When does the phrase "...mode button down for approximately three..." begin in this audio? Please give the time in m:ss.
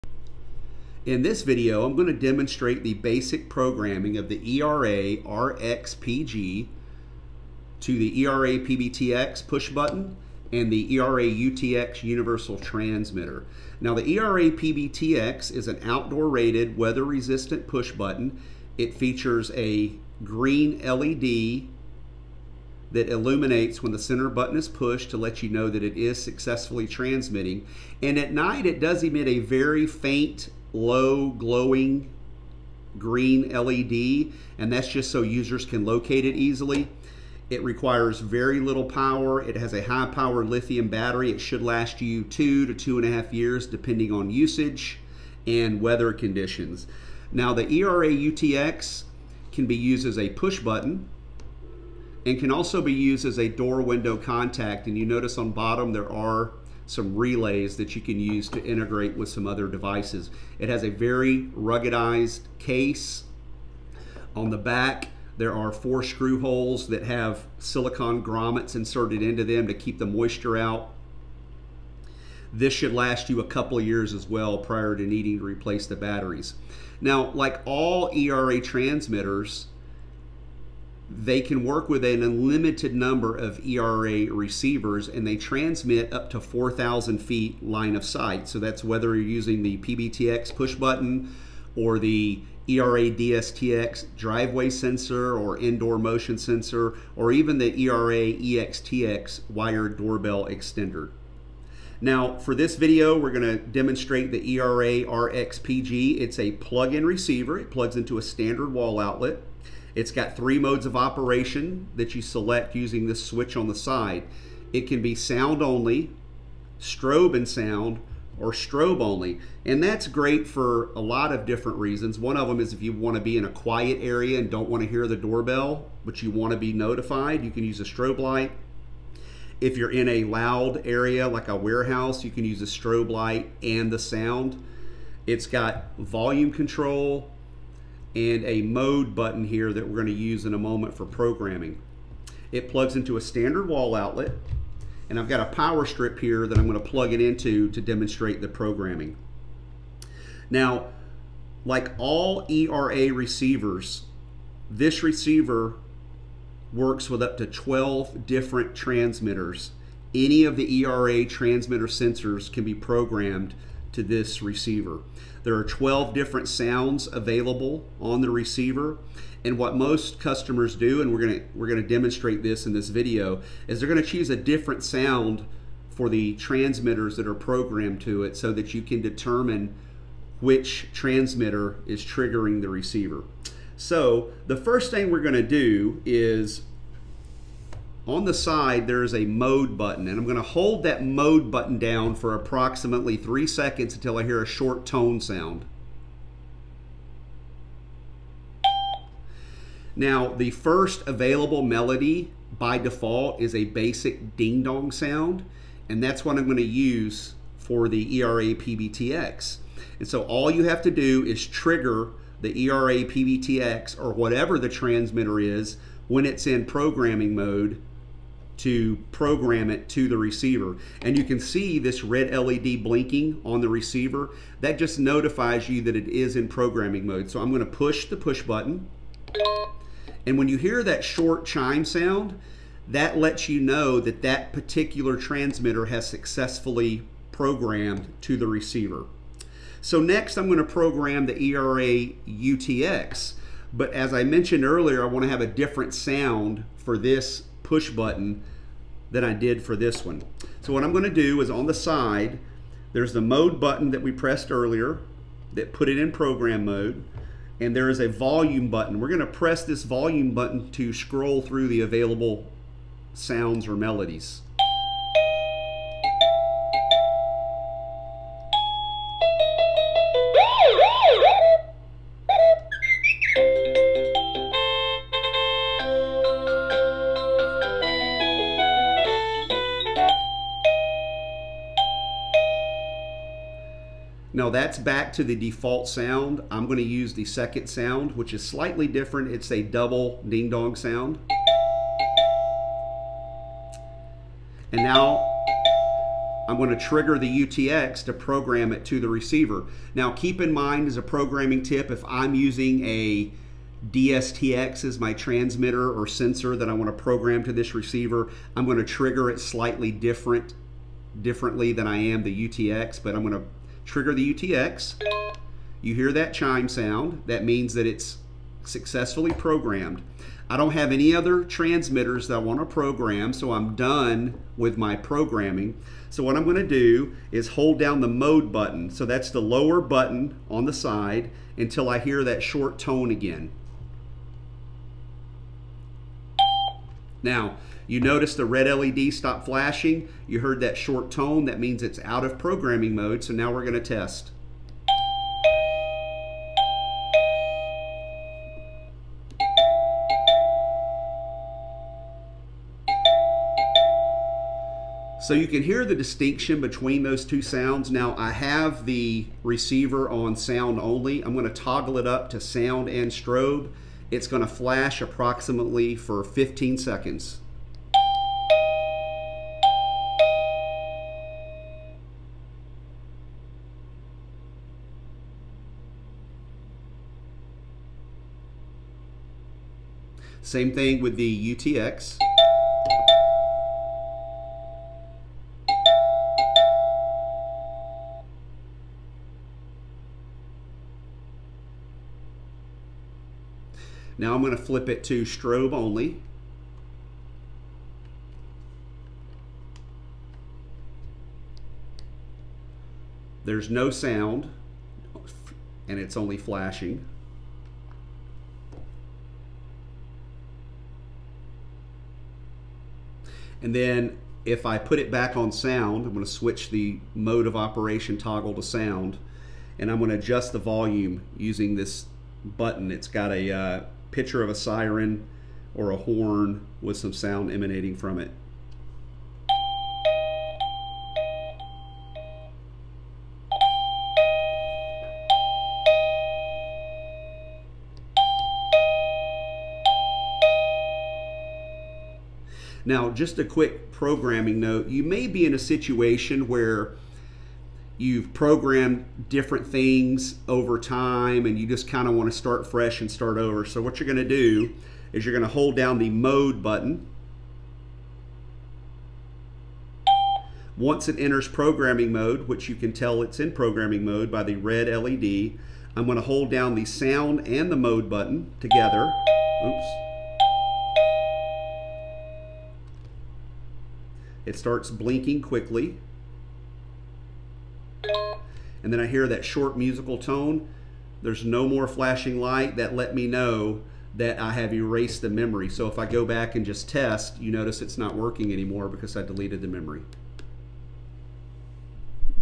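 3:11.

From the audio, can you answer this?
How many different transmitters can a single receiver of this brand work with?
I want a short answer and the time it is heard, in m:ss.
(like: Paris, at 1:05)
12, at 2:37.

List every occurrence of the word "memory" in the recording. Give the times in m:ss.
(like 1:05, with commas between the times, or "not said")
8:05, 8:09.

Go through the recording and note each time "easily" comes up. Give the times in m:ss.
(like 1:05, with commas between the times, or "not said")
0:36.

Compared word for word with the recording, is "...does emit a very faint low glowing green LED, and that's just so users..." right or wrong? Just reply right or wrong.
right.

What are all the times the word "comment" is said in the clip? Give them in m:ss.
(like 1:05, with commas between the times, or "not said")
not said.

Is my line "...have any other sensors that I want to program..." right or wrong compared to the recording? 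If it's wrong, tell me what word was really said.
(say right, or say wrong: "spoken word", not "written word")
wrong: "transmitters", not "sensors".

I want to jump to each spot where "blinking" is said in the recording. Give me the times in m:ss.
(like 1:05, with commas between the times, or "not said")
3:42, 7:54.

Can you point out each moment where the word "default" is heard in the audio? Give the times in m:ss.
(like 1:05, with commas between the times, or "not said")
3:22, 4:45.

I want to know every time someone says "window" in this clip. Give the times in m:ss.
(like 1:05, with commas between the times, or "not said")
0:53.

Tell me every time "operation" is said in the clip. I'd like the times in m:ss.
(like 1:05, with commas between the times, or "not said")
1:50, 6:57.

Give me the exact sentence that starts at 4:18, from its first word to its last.
We're gonna press this volume button to scroll through the available sounds or melodies.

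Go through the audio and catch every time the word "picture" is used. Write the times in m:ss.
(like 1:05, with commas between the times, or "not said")
7:04.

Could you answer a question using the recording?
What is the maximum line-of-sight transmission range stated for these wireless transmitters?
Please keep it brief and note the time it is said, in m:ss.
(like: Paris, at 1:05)
4,000 feet, at 1:26.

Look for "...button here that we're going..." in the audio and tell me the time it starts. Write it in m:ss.
2:19.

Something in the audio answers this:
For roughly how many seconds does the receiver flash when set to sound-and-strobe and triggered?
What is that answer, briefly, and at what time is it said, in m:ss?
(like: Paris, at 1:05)
15 seconds, at 6:06.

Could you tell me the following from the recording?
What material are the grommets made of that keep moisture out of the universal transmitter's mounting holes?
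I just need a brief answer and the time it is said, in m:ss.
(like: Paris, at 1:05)
Silicone, at 1:07.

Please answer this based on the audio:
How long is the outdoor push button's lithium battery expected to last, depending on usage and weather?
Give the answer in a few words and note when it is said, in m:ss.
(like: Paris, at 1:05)
2 to 2.5 years, at 0:42.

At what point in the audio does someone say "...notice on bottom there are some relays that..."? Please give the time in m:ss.
0:55.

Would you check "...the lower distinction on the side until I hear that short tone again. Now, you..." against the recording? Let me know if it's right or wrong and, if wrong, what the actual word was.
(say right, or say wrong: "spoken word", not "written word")
wrong: "button", not "distinction".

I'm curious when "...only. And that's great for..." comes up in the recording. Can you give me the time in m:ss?
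1:59.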